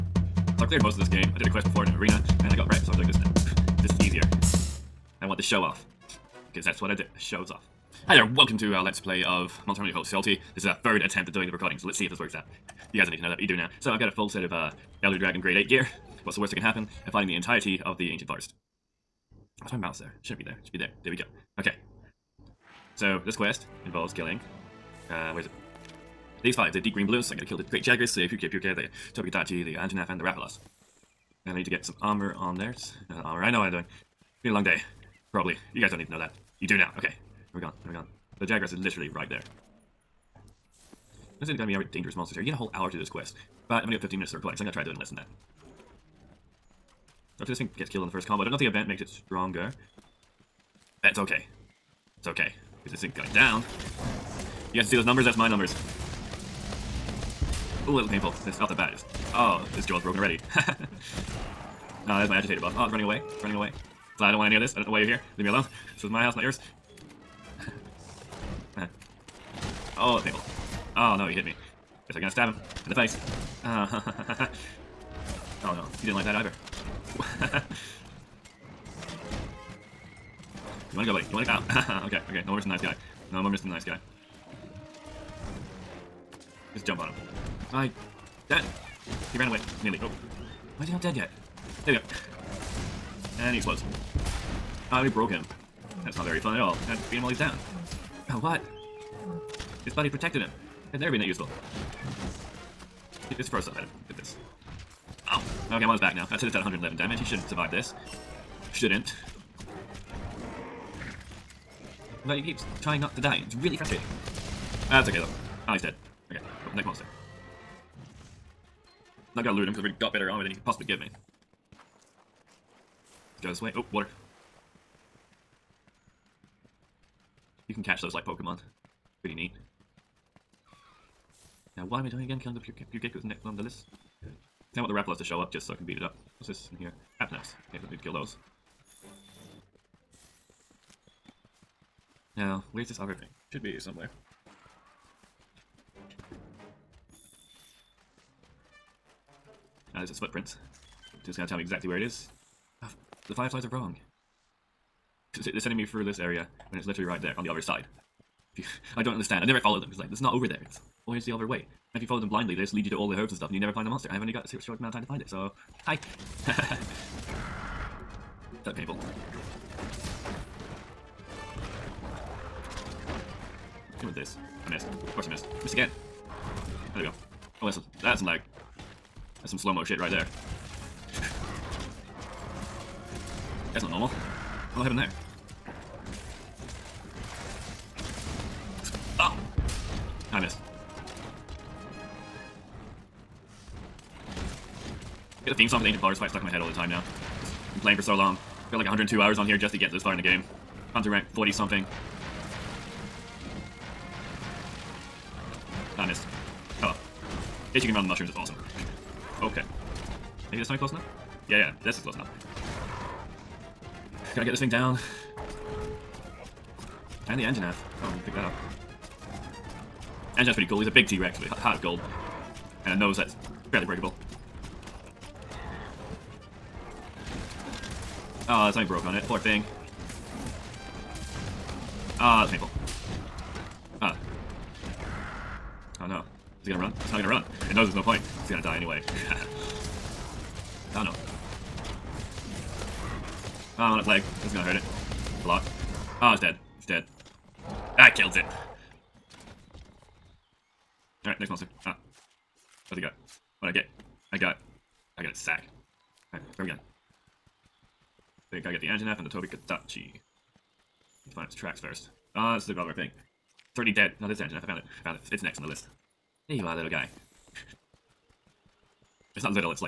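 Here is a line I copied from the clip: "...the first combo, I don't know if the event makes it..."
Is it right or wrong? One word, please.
right.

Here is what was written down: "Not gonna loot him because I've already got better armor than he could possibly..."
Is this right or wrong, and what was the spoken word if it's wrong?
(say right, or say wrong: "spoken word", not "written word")
right.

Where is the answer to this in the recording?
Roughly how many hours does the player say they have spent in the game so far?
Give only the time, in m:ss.
3:18.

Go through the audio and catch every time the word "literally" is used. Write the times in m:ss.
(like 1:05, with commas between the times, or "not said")
0:38, 2:36.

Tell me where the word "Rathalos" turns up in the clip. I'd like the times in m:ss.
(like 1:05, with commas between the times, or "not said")
0:30, 2:14.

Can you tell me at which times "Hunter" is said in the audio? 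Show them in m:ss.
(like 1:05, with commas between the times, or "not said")
0:09, 3:20.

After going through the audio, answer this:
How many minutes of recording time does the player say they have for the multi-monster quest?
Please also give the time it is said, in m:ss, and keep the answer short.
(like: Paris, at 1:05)
15, at 0:44.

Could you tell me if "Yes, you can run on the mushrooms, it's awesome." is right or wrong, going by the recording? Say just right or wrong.
right.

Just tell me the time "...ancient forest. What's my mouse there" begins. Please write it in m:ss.
0:18.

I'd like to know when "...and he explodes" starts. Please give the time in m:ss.
1:33.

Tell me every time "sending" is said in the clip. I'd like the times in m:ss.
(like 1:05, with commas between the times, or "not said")
2:35.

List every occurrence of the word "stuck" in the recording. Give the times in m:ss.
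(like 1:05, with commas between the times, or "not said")
3:16.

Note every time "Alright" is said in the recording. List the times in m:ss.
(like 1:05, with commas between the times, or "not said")
4:11, 4:16.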